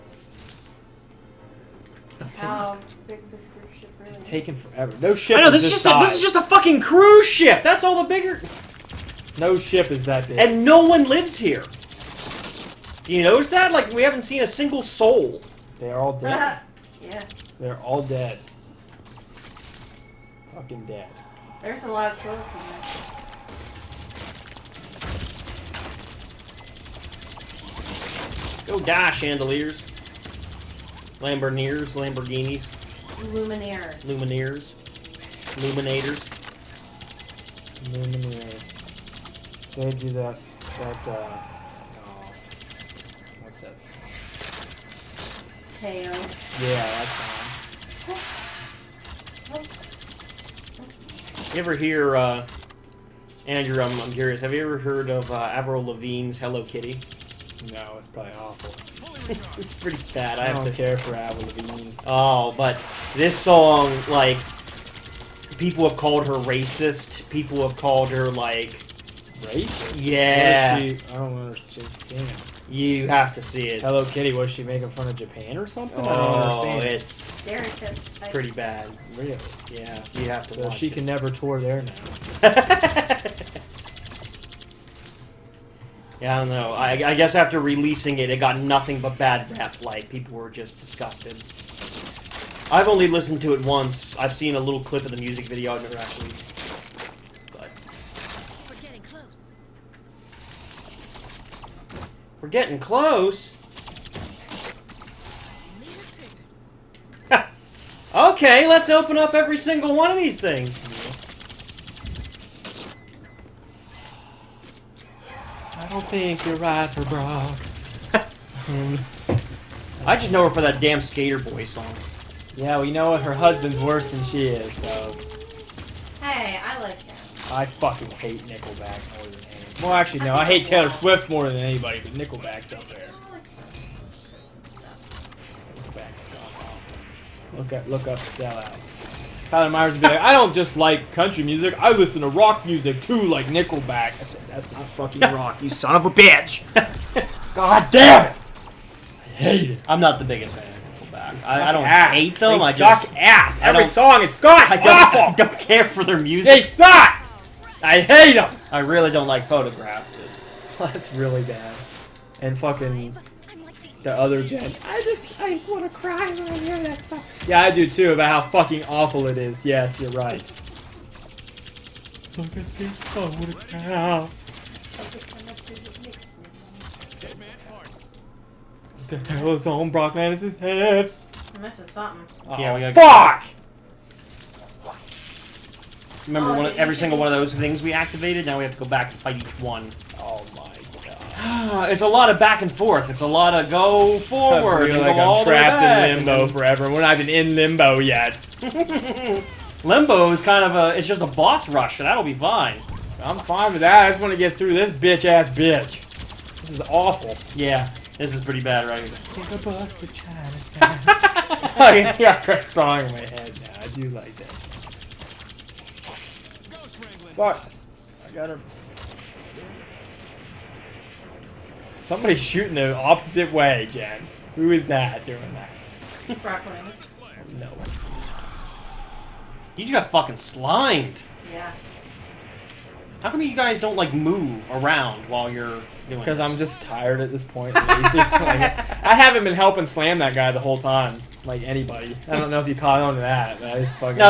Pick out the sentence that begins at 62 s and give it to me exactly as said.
Oh, but this song, like, people have called her racist.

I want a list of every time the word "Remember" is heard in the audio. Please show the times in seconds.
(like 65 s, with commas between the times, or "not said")
186 s.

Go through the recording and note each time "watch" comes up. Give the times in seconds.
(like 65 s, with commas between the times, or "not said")
80 s.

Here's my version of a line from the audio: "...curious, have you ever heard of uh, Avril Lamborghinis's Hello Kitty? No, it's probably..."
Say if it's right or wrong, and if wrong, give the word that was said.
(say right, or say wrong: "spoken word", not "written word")
wrong: "Lavigne", not "Lamborghinis".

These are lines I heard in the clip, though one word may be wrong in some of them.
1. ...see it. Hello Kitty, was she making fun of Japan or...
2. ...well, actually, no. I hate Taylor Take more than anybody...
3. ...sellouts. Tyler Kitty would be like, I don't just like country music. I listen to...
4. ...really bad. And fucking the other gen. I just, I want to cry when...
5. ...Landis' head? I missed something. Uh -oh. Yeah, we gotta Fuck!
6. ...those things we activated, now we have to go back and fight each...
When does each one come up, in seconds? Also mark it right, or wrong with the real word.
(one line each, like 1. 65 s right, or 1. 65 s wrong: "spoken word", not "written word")
1. 73 s right
2. 129 s wrong: "Swift", not "Take"
3. 138 s wrong: "Myers", not "Kitty"
4. 161 s right
5. 180 s right
6. 187 s right.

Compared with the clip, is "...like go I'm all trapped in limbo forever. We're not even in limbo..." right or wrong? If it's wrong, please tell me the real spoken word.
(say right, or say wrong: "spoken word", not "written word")
right.